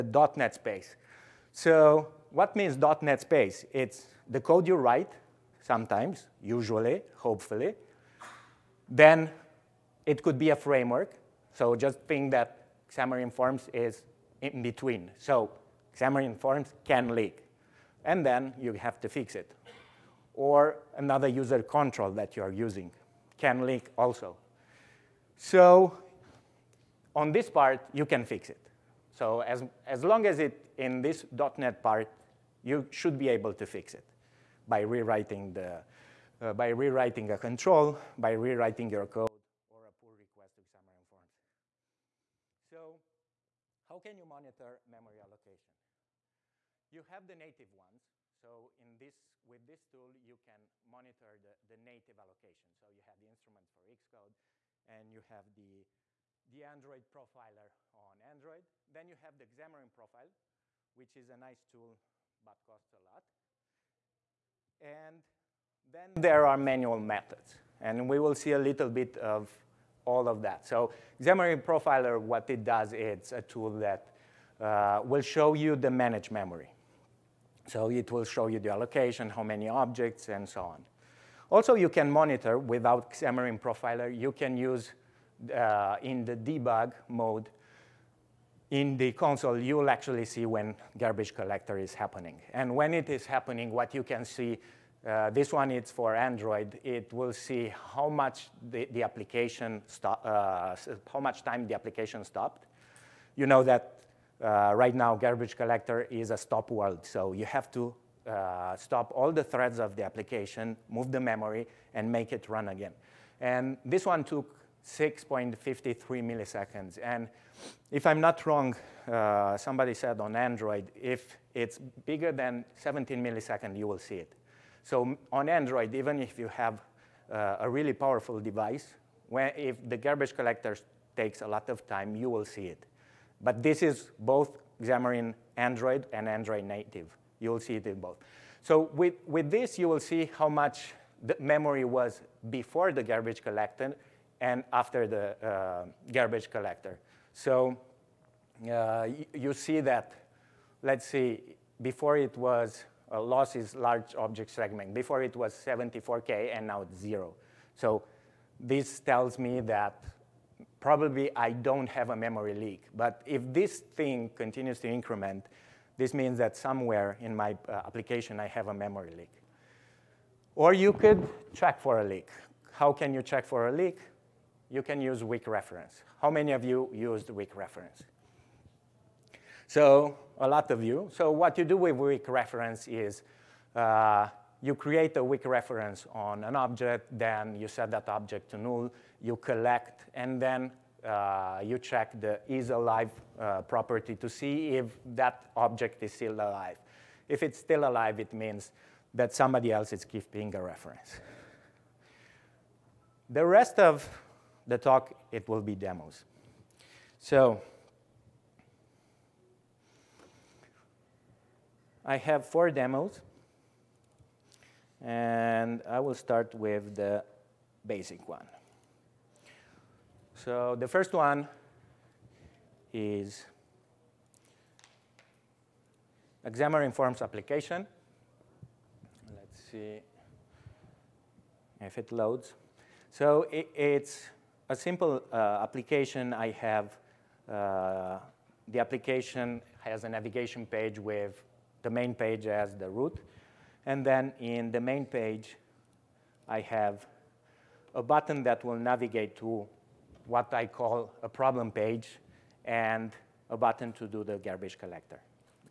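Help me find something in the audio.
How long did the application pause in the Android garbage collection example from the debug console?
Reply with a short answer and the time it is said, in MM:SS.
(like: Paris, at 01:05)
6.53 milliseconds, at 01:54.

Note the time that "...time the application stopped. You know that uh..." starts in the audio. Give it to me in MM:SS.
01:41.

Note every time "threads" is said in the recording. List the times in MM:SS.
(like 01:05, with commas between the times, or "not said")
01:49.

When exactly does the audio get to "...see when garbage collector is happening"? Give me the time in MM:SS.
01:30.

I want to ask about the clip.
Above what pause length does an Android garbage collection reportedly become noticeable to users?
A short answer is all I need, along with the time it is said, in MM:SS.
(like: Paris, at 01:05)
17 milliseconds, at 02:02.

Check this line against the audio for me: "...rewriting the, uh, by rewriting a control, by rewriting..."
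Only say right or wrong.
right.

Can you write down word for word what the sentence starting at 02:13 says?
But this is both Xamarin Android and Android native.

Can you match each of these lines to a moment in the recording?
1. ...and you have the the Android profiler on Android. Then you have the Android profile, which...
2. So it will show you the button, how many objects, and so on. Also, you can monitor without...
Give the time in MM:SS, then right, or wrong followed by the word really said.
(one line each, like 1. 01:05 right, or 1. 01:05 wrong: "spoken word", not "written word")
1. 00:54 wrong: "Xamarin", not "Android"
2. 01:17 wrong: "allocation", not "button".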